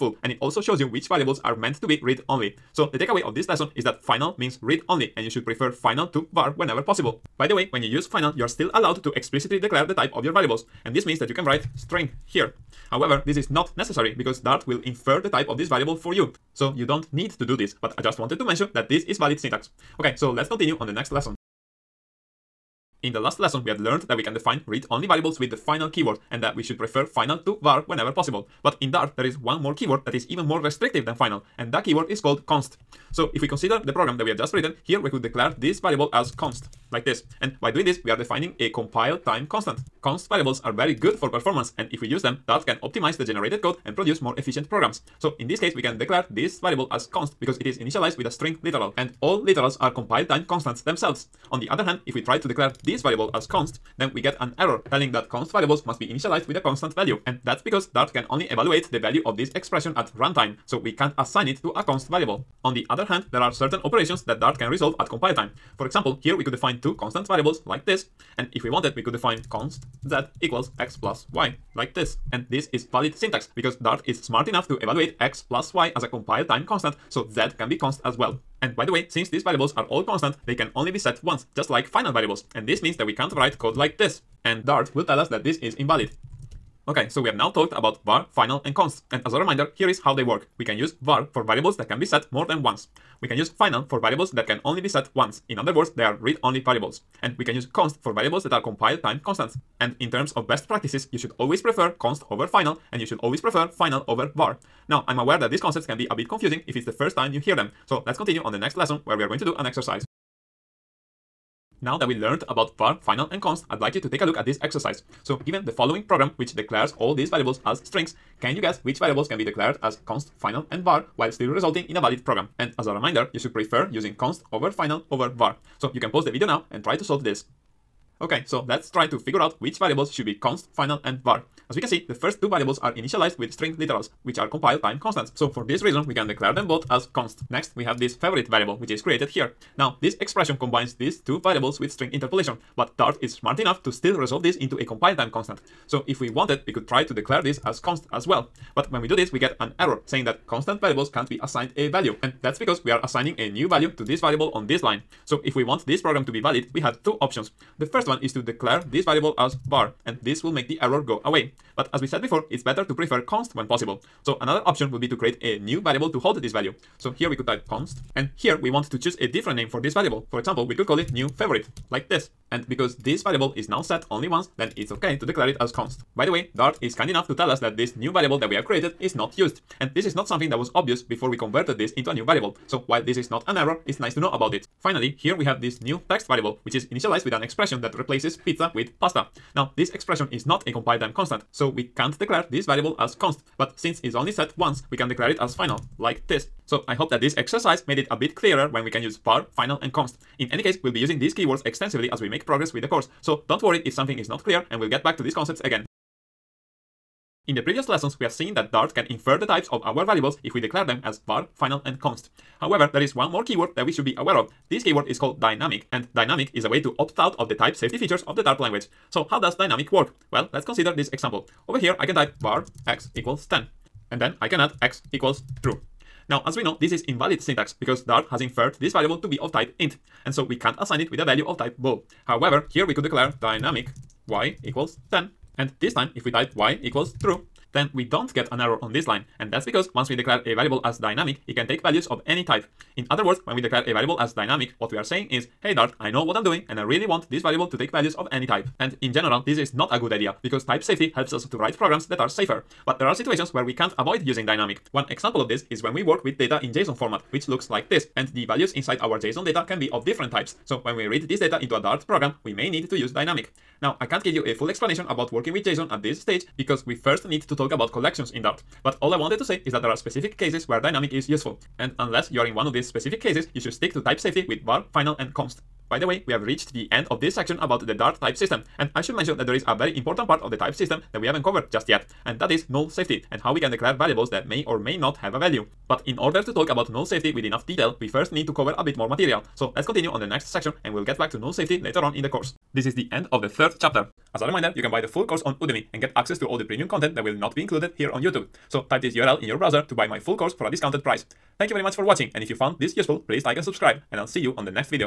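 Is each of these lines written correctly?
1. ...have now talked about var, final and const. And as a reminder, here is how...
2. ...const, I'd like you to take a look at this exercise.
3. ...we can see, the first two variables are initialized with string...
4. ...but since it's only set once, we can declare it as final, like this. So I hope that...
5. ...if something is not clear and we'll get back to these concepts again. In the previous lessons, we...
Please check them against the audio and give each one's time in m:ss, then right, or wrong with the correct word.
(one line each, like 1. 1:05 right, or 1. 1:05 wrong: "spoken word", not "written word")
1. 1:27 right
2. 1:53 right
3. 2:11 right
4. 3:13 right
5. 3:23 right.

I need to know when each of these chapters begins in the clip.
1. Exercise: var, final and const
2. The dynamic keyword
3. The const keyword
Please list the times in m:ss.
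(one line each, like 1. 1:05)
1. 1:49
2. 3:26
3. 0:21.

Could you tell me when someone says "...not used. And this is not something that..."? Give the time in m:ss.
2:59.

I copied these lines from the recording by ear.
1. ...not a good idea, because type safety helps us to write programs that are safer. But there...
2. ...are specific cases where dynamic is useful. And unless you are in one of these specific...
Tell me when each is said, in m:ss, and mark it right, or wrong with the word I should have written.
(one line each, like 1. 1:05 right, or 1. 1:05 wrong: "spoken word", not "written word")
1. 4:09 right
2. 4:29 right.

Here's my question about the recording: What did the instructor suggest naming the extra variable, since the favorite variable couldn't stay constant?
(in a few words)
new favorite.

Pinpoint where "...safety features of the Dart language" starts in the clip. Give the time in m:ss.
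3:37.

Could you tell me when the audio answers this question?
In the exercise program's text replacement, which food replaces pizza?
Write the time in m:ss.
3:09.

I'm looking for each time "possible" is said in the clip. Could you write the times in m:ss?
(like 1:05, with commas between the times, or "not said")
0:06, 0:28, 2:43.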